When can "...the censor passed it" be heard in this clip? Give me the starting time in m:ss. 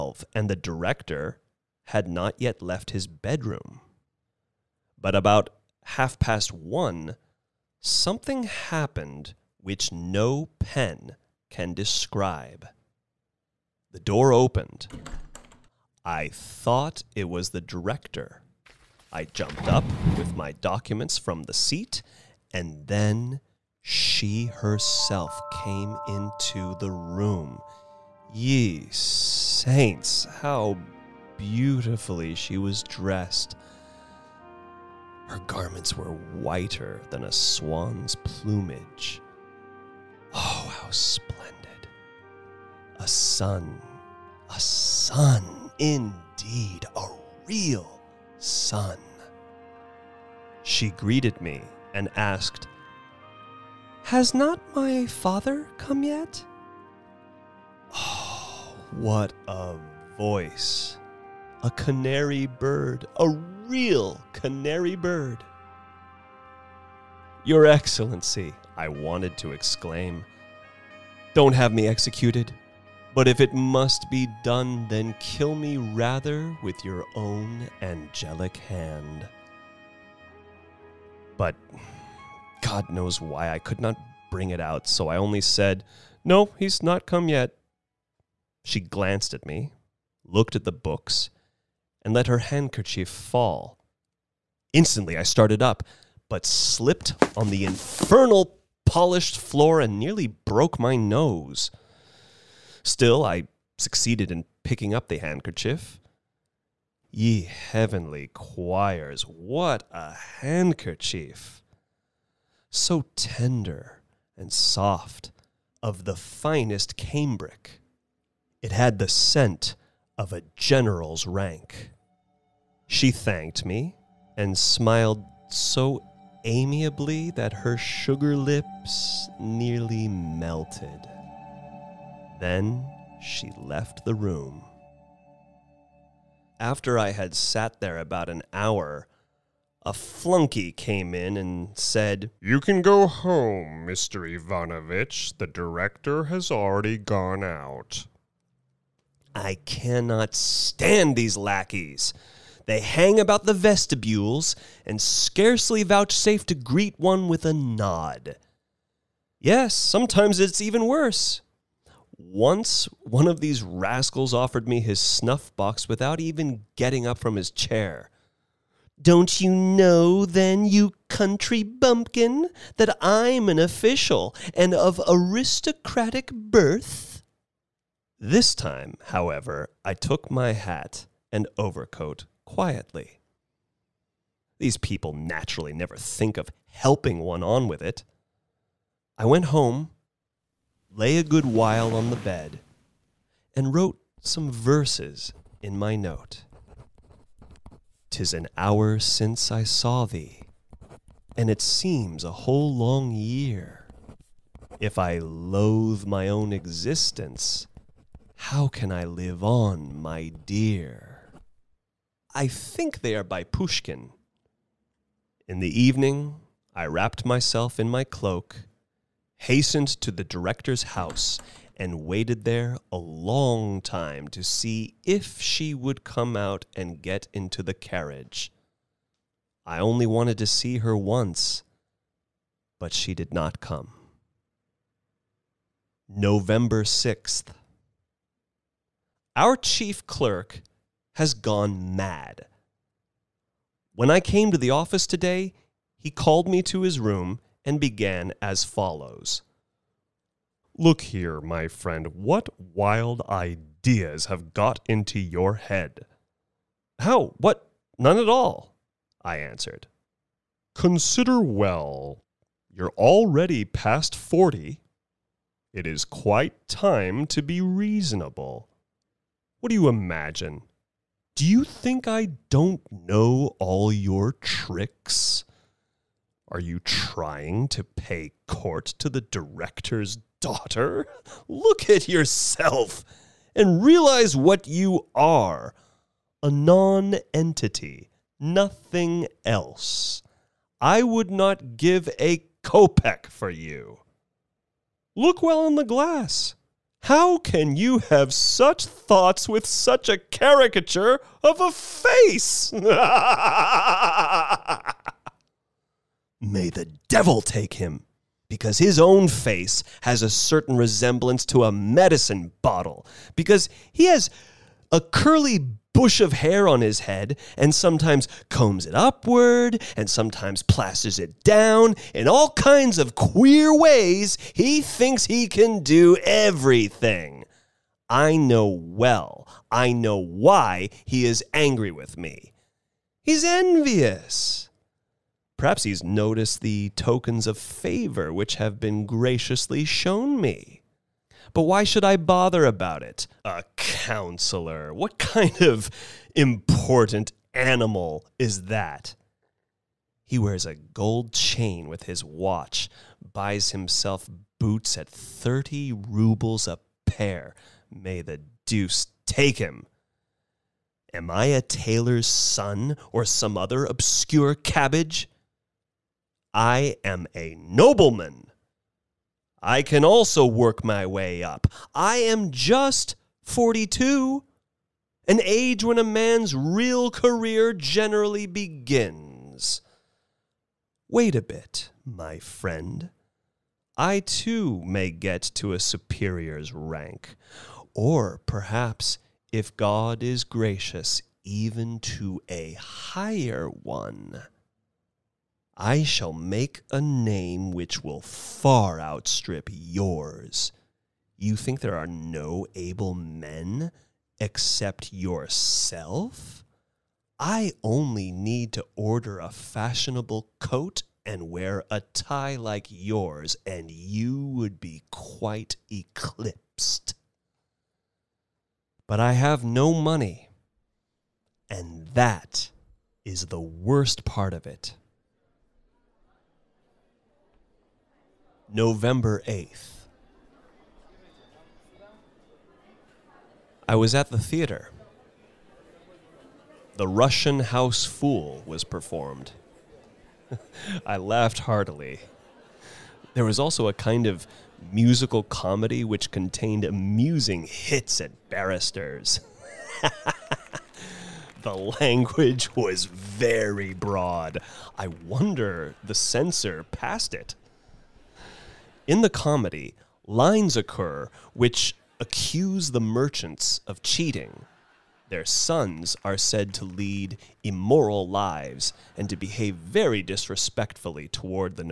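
7:36.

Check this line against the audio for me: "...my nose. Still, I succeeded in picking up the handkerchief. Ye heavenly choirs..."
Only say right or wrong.
right.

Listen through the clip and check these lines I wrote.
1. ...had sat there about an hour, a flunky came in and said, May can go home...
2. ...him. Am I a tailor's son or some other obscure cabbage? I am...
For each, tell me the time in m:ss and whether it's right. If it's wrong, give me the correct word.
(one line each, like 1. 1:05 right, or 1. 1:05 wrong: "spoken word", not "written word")
1. 2:17 wrong: "You", not "May"
2. 5:59 right.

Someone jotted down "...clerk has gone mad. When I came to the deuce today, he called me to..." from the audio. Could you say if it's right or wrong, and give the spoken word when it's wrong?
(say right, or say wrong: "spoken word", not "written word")
wrong: "office", not "deuce".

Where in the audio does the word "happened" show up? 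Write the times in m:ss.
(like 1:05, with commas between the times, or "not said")
0:08.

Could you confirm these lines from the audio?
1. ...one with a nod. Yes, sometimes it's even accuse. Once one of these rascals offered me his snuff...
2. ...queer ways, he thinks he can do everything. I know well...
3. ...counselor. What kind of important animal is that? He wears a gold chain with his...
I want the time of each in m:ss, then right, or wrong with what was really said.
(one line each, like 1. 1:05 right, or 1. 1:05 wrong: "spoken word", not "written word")
1. 2:36 wrong: "worse", not "accuse"
2. 5:23 right
3. 5:43 right.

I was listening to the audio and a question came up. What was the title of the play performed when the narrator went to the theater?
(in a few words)
The Russian House Fool.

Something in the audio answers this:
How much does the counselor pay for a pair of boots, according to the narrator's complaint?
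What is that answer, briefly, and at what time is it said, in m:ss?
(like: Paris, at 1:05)
30 roubles, at 5:55.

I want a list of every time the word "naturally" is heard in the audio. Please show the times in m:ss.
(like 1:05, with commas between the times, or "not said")
3:05.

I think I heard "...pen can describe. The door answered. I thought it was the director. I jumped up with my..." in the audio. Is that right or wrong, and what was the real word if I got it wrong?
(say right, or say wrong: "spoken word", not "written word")
wrong: "opened", not "answered".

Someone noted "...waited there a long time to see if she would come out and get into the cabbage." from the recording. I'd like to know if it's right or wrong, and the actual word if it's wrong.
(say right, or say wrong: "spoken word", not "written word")
wrong: "carriage", not "cabbage".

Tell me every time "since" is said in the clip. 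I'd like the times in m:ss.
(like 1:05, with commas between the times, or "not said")
3:18.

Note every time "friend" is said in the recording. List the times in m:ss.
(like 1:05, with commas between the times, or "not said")
4:11, 6:22.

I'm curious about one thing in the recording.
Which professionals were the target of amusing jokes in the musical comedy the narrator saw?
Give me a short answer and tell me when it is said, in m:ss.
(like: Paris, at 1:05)
Barristers, at 7:28.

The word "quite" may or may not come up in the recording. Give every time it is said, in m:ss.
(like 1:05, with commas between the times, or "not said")
4:26, 6:55.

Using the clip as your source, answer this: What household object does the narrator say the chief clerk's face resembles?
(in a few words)
Medicine bottle.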